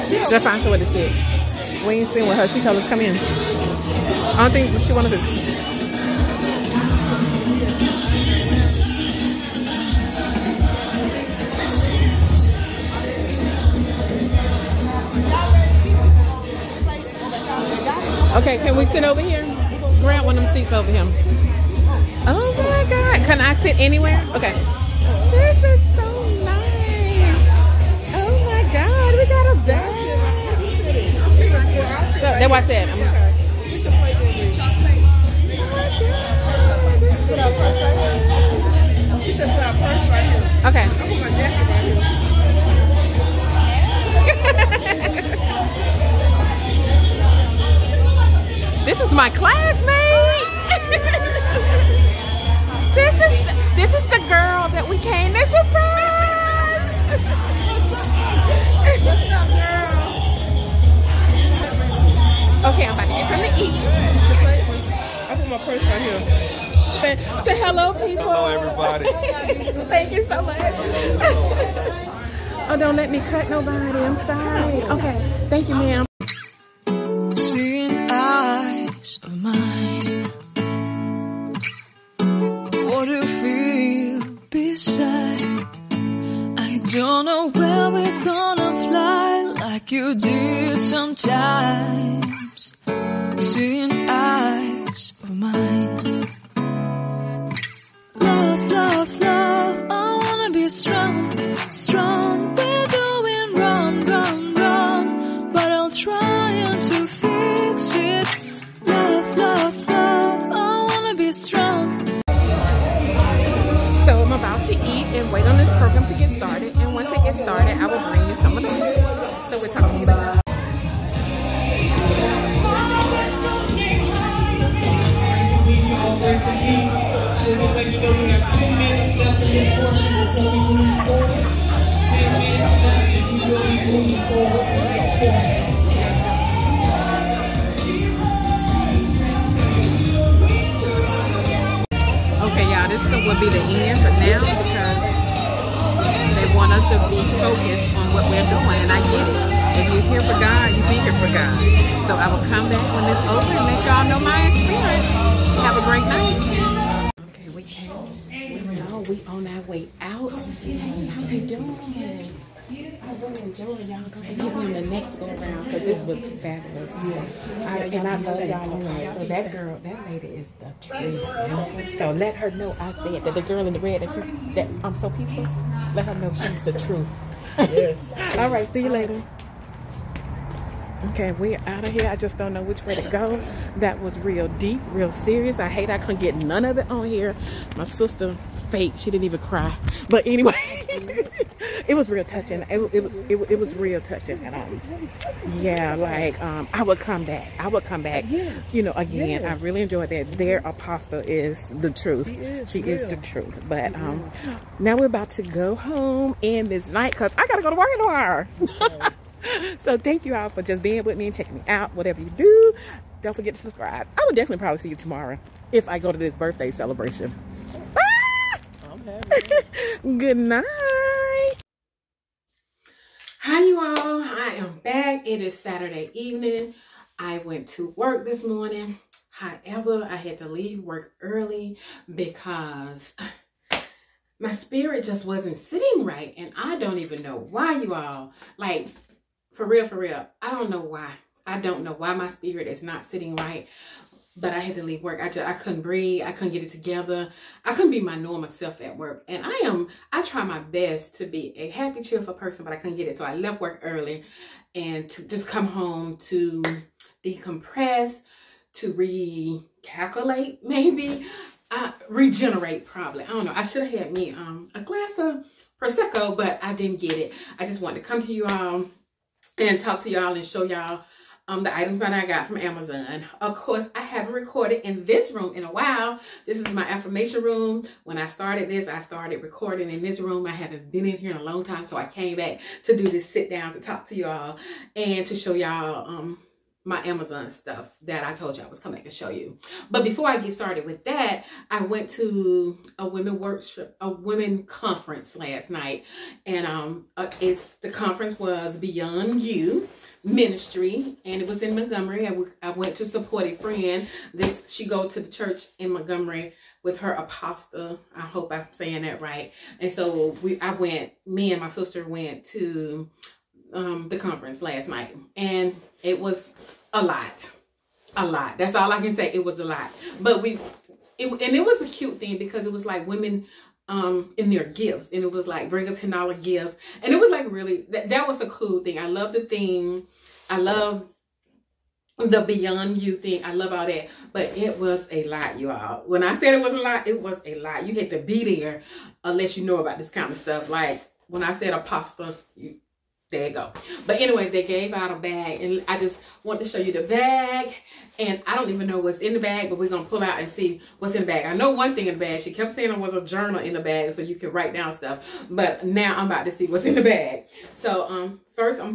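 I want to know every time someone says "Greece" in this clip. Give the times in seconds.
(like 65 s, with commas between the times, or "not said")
not said.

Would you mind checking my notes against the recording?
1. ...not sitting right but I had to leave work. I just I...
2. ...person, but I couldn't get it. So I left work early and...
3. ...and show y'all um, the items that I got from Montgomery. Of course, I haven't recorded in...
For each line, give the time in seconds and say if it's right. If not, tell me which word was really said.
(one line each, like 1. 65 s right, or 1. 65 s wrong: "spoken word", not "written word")
1. 242 s right
2. 252 s right
3. 270 s wrong: "Amazon", not "Montgomery".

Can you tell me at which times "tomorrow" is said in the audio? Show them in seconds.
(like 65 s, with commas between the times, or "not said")
207 s, 214 s.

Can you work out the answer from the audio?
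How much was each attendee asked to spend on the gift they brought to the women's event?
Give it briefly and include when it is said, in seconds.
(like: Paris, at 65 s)
$10, at 325 s.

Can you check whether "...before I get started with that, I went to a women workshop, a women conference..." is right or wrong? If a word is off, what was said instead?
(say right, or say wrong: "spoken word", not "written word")
right.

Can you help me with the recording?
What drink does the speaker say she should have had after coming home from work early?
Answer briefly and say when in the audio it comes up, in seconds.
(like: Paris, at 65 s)
Prosecco, at 265 s.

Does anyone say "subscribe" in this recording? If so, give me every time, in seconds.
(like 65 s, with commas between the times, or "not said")
213 s.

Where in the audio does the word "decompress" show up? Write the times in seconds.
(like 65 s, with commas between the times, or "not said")
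257 s.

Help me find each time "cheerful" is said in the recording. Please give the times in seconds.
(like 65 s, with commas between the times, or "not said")
252 s.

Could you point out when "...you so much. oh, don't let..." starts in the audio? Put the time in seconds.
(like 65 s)
70 s.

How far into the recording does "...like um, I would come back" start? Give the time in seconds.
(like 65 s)
195 s.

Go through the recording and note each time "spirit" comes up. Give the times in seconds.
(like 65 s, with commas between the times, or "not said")
234 s, 242 s.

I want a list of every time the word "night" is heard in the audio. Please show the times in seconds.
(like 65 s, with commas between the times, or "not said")
156 s, 206 s, 220 s, 295 s, 314 s.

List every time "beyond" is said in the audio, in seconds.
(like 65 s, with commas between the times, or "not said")
298 s, 332 s.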